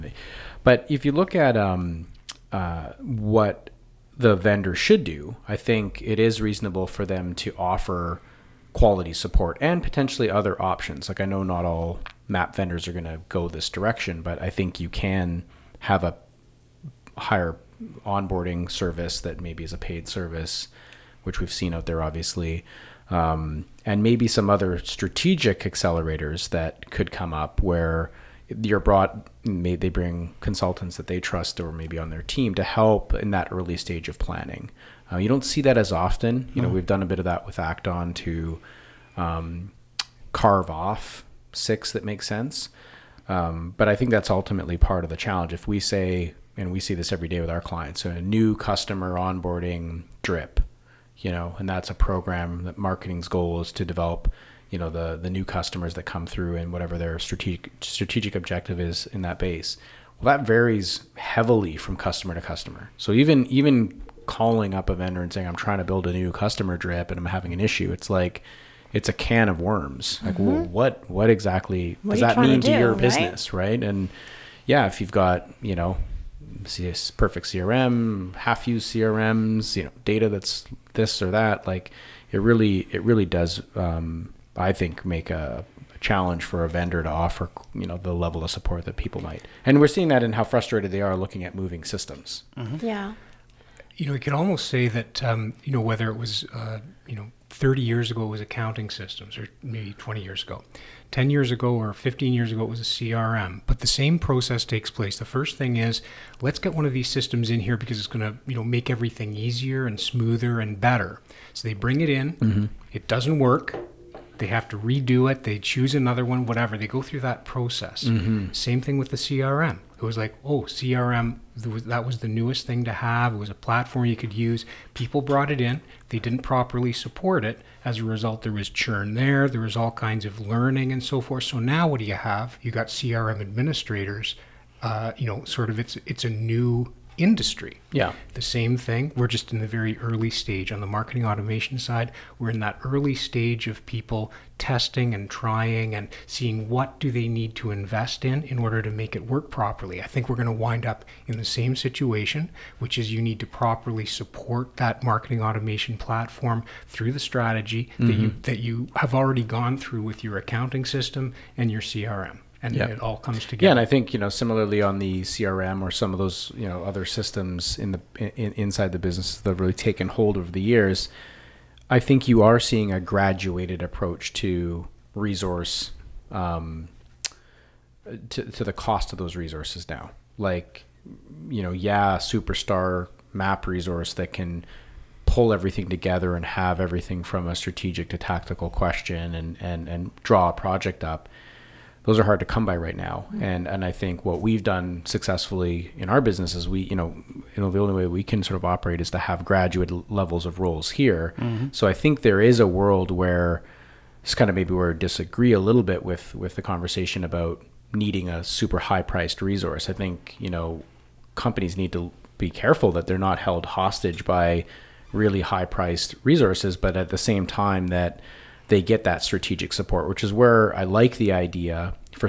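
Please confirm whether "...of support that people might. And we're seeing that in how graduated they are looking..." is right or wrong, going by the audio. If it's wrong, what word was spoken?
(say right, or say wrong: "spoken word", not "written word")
wrong: "frustrated", not "graduated".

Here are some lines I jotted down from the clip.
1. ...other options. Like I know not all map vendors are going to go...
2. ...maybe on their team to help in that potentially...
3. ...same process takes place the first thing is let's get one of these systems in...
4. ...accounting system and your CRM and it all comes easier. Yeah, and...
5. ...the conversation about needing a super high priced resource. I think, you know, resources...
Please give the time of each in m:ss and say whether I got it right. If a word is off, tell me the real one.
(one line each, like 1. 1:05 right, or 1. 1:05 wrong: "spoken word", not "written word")
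1. 0:10 right
2. 0:31 wrong: "early", not "potentially"
3. 1:43 right
4. 2:40 wrong: "together", not "easier"
5. 3:26 wrong: "companies", not "resources".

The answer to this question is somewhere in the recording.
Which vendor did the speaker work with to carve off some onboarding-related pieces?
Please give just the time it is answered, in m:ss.
0:37.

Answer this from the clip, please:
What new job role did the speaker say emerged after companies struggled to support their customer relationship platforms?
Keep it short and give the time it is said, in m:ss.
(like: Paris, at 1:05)
CRM administrators, at 2:12.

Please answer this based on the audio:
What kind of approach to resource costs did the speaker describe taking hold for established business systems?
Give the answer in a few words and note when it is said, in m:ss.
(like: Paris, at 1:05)
graduated approach, at 2:53.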